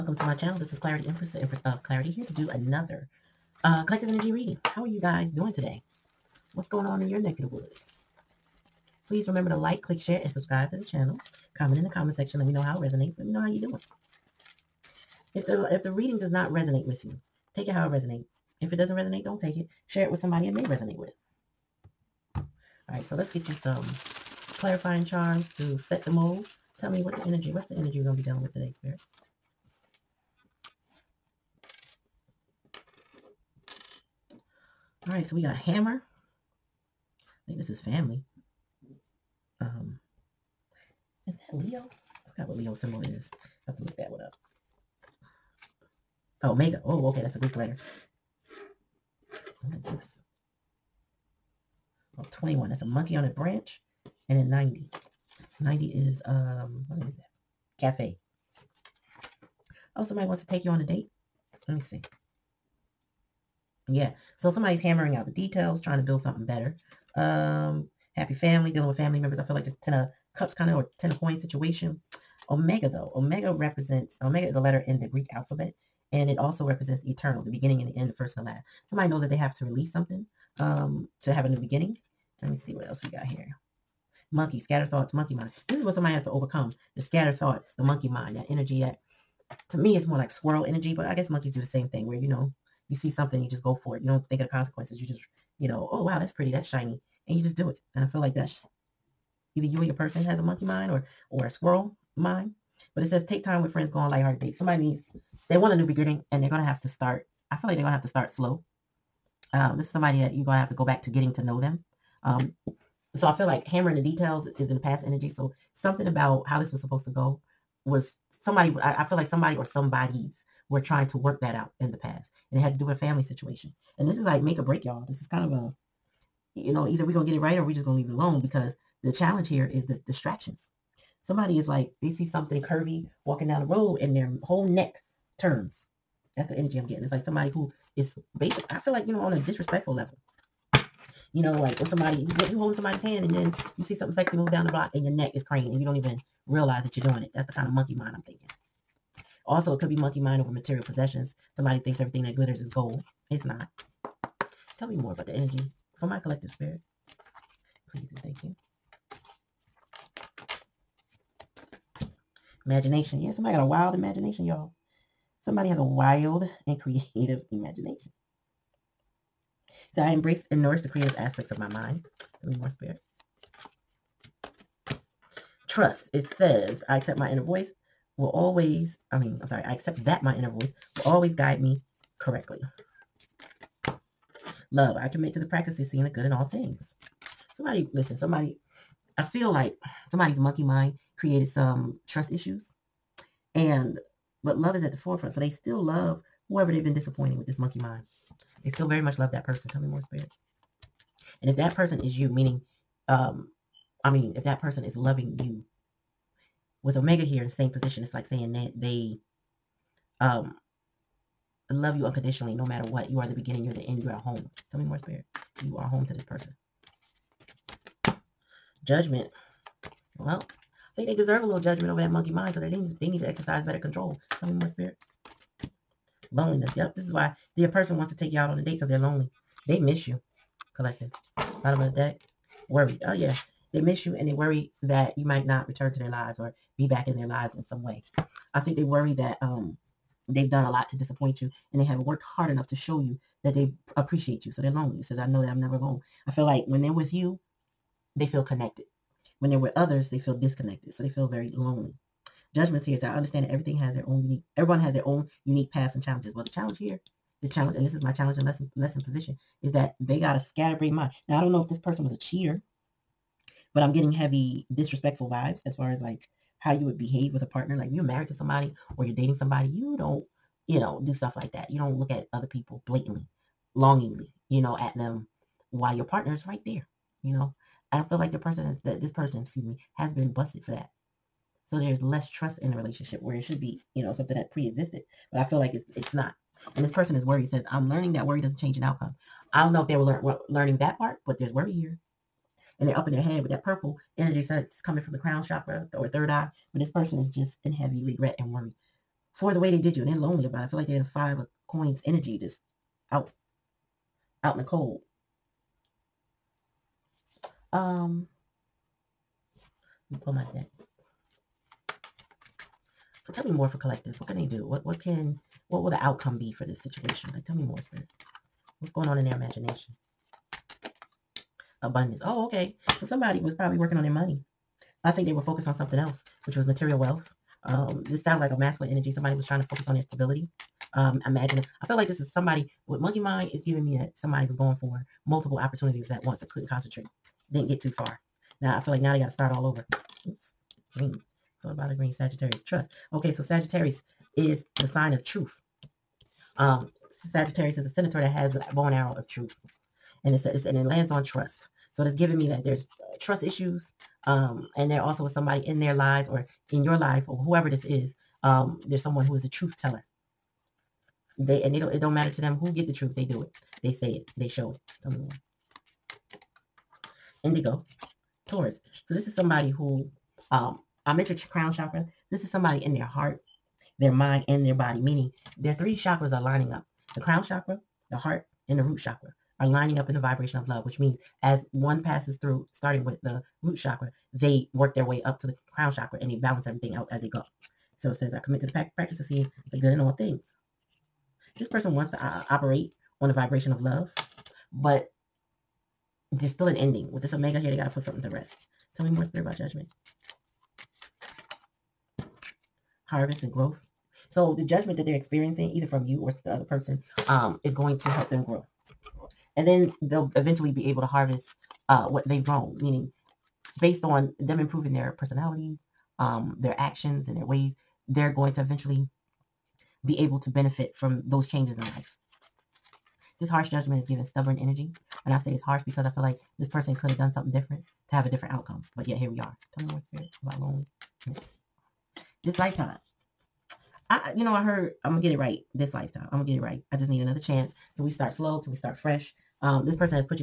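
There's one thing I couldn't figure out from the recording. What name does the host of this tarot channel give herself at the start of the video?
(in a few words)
Clarity Empress.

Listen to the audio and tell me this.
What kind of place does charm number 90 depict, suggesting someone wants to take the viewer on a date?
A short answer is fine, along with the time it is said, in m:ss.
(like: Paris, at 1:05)
Cafe, at 0:57.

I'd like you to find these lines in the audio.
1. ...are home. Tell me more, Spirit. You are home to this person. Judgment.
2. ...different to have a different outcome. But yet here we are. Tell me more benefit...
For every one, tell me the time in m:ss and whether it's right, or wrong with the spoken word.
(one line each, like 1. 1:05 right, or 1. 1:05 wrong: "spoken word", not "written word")
1. 3:34 right
2. 7:07 wrong: "spirit", not "benefit".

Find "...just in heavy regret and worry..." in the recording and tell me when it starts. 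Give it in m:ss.
4:57.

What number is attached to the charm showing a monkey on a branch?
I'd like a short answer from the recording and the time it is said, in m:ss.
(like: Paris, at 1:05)
21, at 0:52.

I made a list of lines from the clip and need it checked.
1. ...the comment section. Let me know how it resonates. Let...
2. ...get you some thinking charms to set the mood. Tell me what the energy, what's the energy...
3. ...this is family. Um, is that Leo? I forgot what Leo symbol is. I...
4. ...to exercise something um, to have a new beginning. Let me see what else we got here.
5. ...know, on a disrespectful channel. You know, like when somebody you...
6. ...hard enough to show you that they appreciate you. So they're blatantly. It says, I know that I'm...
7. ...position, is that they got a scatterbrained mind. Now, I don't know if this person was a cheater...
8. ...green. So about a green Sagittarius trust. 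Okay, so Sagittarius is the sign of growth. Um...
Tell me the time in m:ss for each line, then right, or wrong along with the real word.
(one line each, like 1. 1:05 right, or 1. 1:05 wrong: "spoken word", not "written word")
1. 0:11 right
2. 0:23 wrong: "clarifying", not "thinking"
3. 0:37 right
4. 1:19 wrong: "release", not "exercise"
5. 2:19 wrong: "level", not "channel"
6. 4:02 wrong: "lonely", not "blatantly"
7. 4:19 right
8. 5:40 wrong: "truth", not "growth".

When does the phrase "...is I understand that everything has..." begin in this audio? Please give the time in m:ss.
4:12.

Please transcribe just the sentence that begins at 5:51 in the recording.
So it's giving me that there's uh, trust issues.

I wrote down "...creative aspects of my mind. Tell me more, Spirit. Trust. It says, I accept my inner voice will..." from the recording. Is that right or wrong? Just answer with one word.
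right.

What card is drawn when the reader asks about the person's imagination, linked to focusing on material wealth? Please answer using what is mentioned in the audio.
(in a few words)
Abundance.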